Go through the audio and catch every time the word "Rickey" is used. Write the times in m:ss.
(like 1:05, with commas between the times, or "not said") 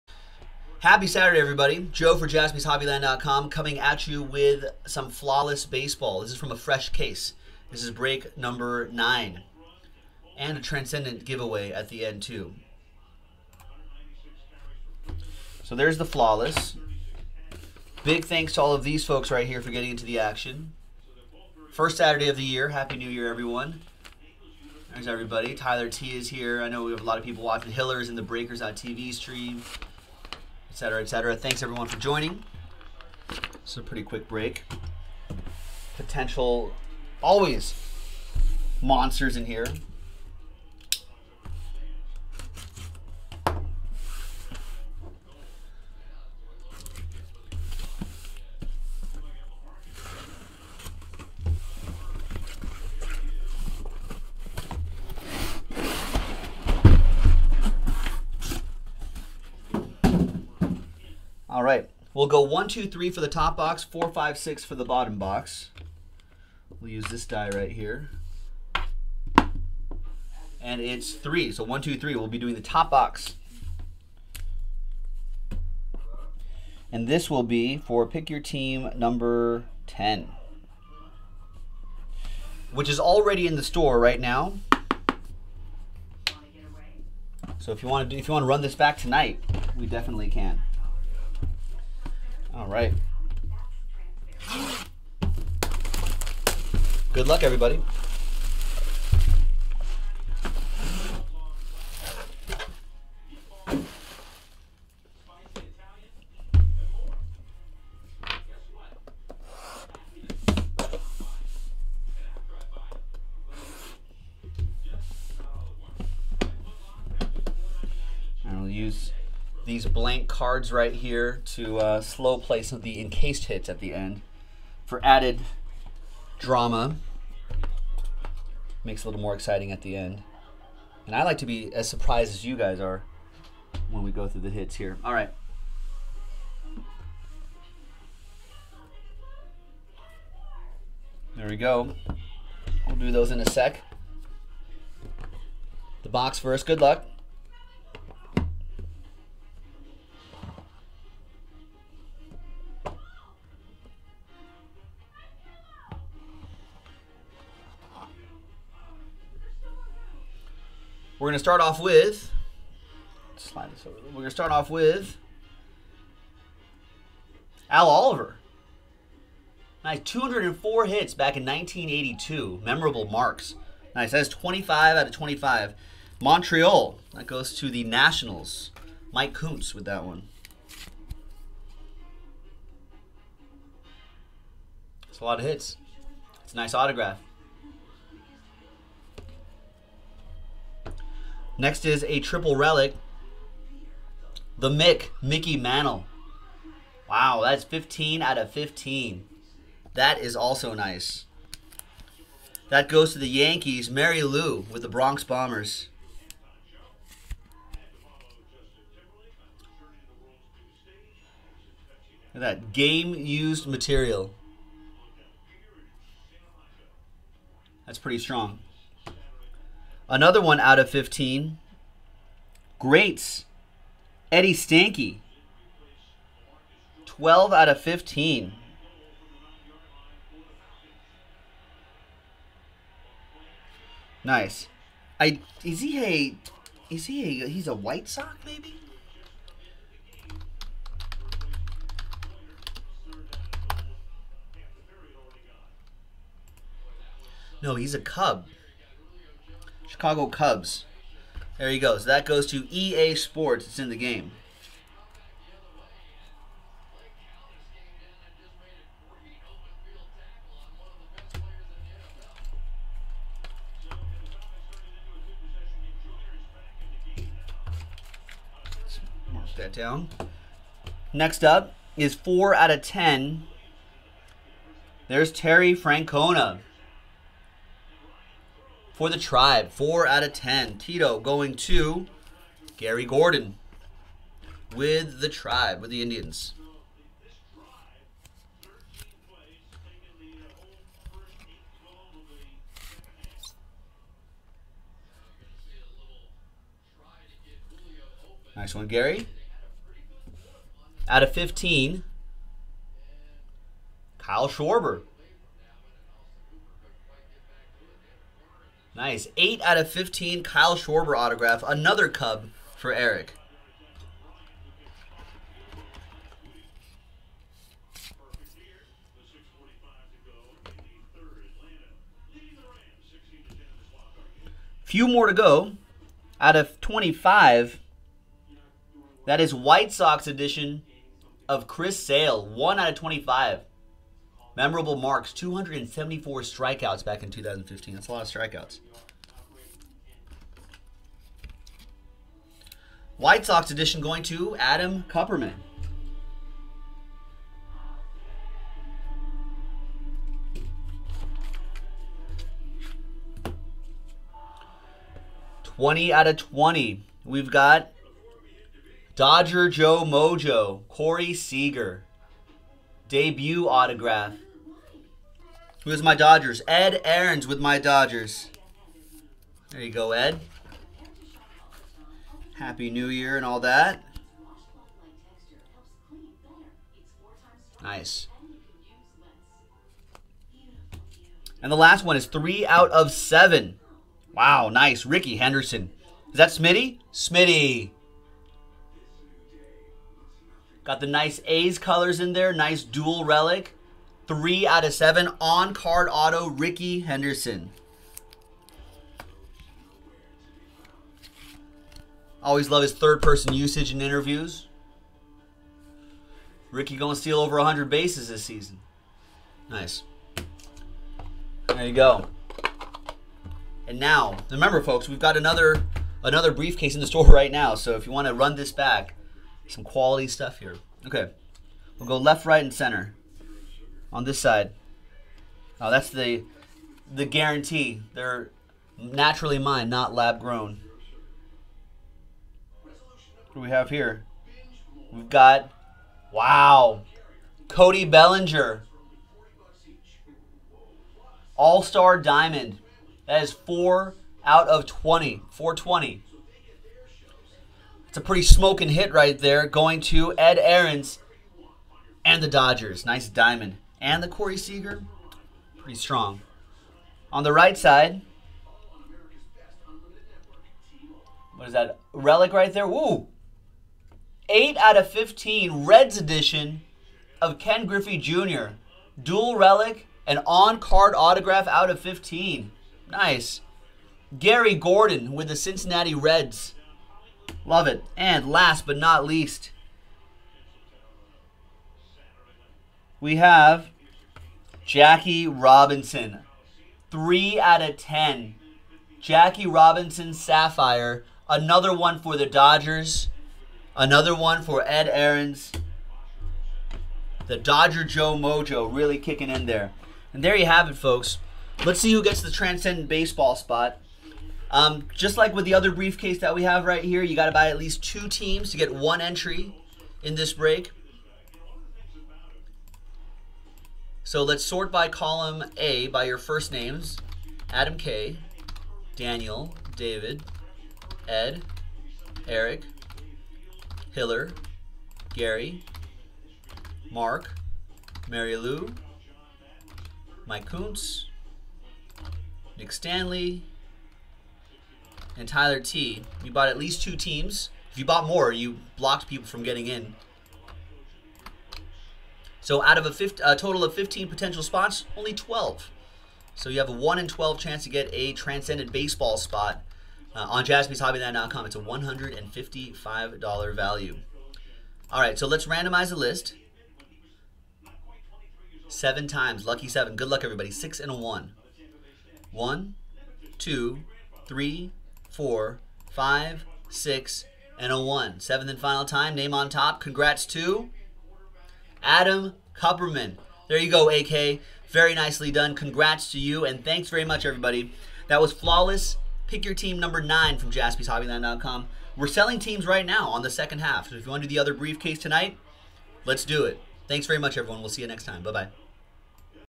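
6:25, 6:36, 6:46.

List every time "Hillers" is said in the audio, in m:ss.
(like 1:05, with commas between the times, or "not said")
0:27, 8:44.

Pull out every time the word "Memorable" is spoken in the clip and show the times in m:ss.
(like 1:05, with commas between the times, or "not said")
2:52, 5:34.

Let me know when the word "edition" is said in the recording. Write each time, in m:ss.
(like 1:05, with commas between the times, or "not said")
5:30, 5:43, 7:46.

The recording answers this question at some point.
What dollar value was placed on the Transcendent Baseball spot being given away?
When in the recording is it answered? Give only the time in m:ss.
9:11.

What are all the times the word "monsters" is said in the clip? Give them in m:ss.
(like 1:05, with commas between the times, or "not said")
0:38.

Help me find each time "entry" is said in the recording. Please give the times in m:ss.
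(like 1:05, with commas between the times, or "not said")
8:29.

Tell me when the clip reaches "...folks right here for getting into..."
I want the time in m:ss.
0:19.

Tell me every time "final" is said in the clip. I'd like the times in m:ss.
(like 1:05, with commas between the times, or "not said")
9:28.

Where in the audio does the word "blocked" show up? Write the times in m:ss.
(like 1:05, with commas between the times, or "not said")
8:58.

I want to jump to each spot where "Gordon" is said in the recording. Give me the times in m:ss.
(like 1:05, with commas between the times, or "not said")
4:43, 7:54.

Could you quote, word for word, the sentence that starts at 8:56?
You bought at least two teams.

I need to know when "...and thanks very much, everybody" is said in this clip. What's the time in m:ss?
9:36.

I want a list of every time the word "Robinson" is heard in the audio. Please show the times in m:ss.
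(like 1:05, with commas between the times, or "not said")
8:05, 8:09.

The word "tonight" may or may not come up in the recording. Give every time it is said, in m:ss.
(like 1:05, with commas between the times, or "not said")
1:28, 9:45.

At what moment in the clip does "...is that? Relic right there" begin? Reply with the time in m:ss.
7:41.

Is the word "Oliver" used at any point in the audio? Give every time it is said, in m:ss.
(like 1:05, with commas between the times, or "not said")
2:47.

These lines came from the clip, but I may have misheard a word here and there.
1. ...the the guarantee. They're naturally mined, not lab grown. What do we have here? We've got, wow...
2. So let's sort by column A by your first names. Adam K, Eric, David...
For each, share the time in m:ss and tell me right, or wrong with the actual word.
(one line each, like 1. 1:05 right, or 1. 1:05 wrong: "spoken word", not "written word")
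1. 7:06 right
2. 8:34 wrong: "Daniel", not "Eric".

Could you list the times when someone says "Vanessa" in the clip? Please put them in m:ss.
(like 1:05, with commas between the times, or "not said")
not said.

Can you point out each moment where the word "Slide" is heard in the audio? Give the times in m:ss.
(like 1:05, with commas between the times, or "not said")
2:43.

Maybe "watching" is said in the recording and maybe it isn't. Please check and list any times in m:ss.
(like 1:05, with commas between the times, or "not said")
0:27.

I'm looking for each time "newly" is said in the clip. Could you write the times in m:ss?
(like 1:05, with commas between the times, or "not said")
not said.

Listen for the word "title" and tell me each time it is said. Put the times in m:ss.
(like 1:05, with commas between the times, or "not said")
not said.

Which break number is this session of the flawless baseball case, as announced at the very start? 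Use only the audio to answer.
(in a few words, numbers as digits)
9.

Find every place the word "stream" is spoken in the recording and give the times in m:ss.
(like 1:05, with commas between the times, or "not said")
0:29.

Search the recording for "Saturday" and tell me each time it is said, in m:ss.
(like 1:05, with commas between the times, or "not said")
0:01, 0:21.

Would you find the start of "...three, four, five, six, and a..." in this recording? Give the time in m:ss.
9:24.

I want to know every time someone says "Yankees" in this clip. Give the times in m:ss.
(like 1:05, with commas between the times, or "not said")
3:23.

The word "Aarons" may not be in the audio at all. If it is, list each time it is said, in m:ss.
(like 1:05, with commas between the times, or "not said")
6:07, 7:30, 8:15.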